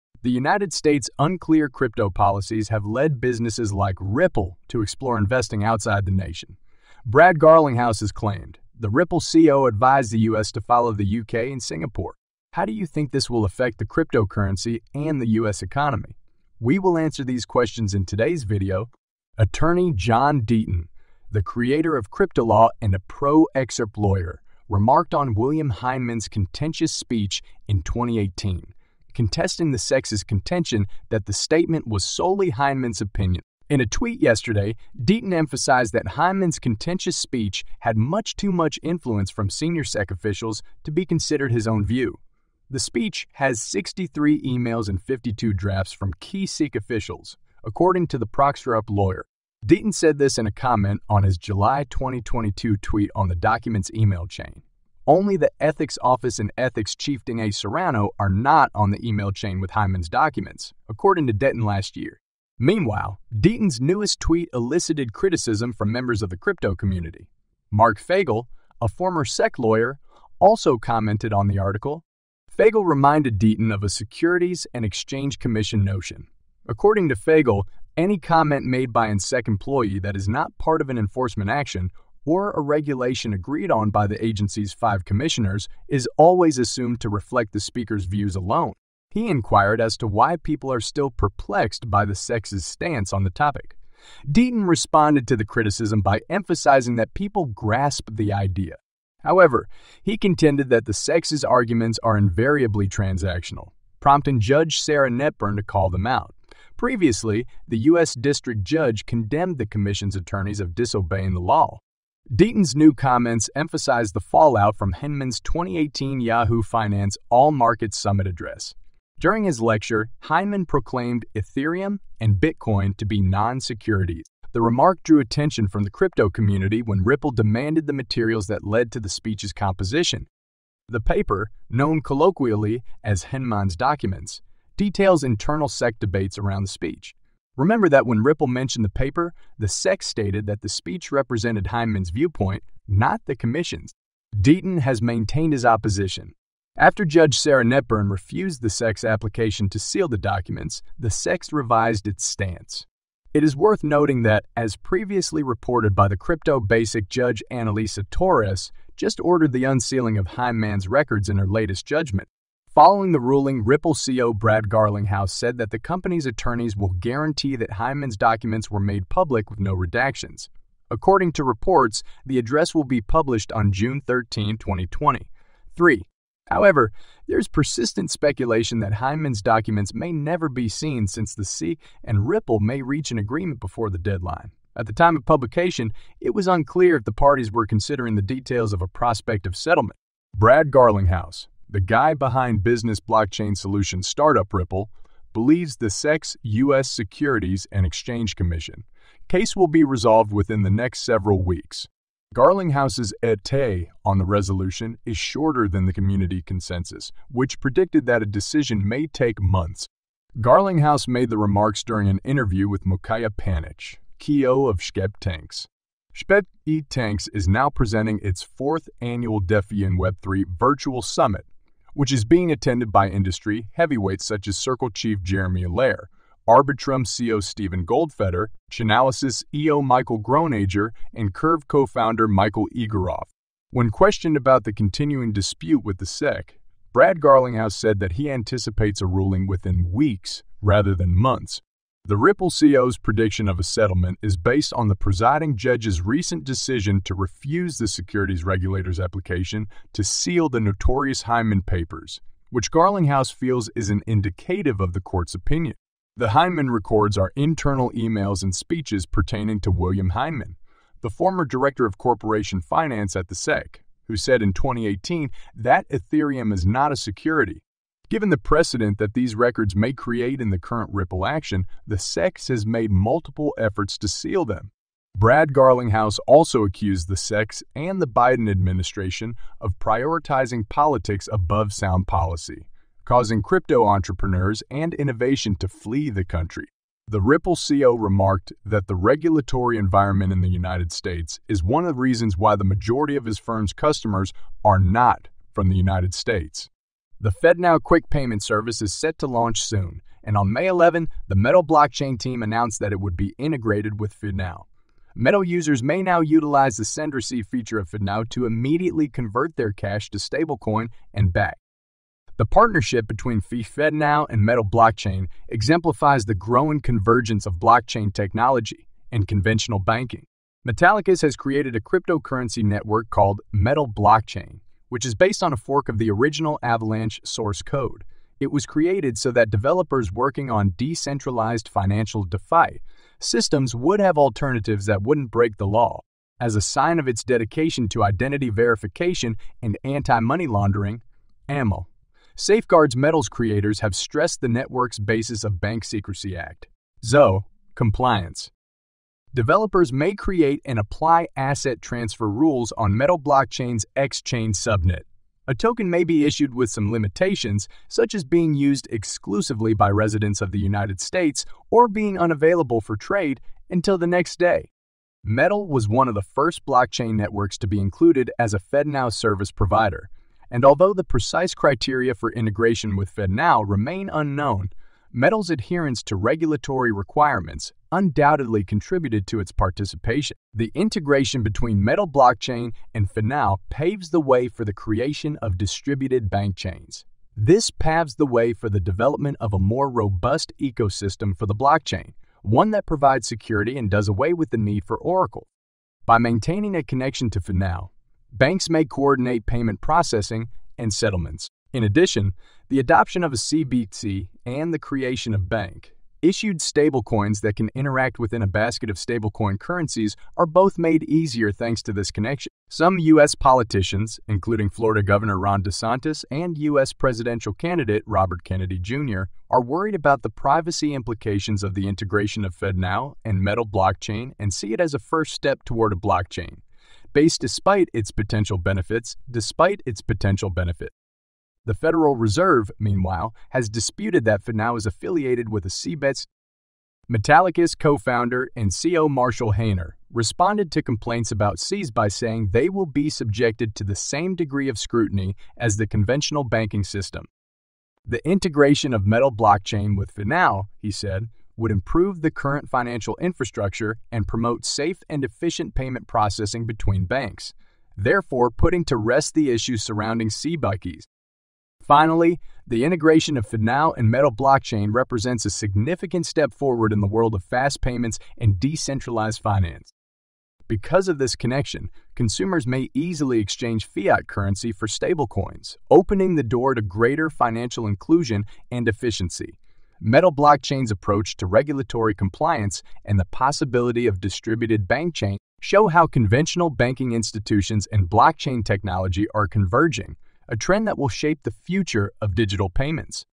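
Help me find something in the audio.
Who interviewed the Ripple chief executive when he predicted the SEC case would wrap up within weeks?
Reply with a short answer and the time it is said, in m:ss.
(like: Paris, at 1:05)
Mukaya Panich, at 3:32.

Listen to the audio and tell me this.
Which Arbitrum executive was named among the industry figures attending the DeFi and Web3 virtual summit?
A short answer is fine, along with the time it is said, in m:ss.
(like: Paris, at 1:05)
Steven Goldfeder, at 3:47.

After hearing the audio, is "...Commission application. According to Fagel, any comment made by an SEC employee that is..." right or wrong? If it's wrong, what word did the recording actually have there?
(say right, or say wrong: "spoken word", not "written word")
wrong: "notion", not "application".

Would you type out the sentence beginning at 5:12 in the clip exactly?
The partnership between FedNow and Metal blockchain exemplifies the growing convergence of blockchain technology and conventional banking.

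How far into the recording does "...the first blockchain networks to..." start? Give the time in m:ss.
6:06.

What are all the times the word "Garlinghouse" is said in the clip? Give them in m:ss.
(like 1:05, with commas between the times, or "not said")
0:07, 2:44, 3:10, 3:22, 3:30, 3:57, 4:12, 4:35.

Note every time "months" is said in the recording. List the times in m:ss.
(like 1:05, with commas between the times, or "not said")
3:29, 4:01.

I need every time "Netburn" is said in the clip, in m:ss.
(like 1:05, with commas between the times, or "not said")
1:45, 2:27.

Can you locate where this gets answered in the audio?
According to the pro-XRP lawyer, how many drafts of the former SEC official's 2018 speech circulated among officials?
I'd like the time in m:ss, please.
0:45.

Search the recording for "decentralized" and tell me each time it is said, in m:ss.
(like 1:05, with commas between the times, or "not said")
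5:30, 7:48.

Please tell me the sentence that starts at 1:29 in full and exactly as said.
He inquired as to why people are still perplexed by the SEC's stance on the topic.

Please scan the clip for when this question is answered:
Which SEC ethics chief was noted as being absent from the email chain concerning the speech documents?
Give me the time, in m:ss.
0:57.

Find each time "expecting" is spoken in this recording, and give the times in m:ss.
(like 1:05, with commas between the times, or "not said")
not said.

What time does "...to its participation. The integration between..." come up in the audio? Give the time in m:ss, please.
6:19.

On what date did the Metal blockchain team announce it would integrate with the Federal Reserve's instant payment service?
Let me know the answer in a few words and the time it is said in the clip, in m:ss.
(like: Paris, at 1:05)
May 11, at 5:00.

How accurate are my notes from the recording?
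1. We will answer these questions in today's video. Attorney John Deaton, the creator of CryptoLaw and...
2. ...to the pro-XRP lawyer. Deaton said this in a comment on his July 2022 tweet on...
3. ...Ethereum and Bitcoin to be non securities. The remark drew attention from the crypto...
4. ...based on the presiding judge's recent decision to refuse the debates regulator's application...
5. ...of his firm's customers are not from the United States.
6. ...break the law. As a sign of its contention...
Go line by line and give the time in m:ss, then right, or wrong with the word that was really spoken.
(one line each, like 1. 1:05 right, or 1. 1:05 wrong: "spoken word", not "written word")
1. 0:16 right
2. 0:48 right
3. 2:01 right
4. 4:04 wrong: "securities", not "debates"
5. 4:53 right
6. 5:35 wrong: "dedication", not "contention".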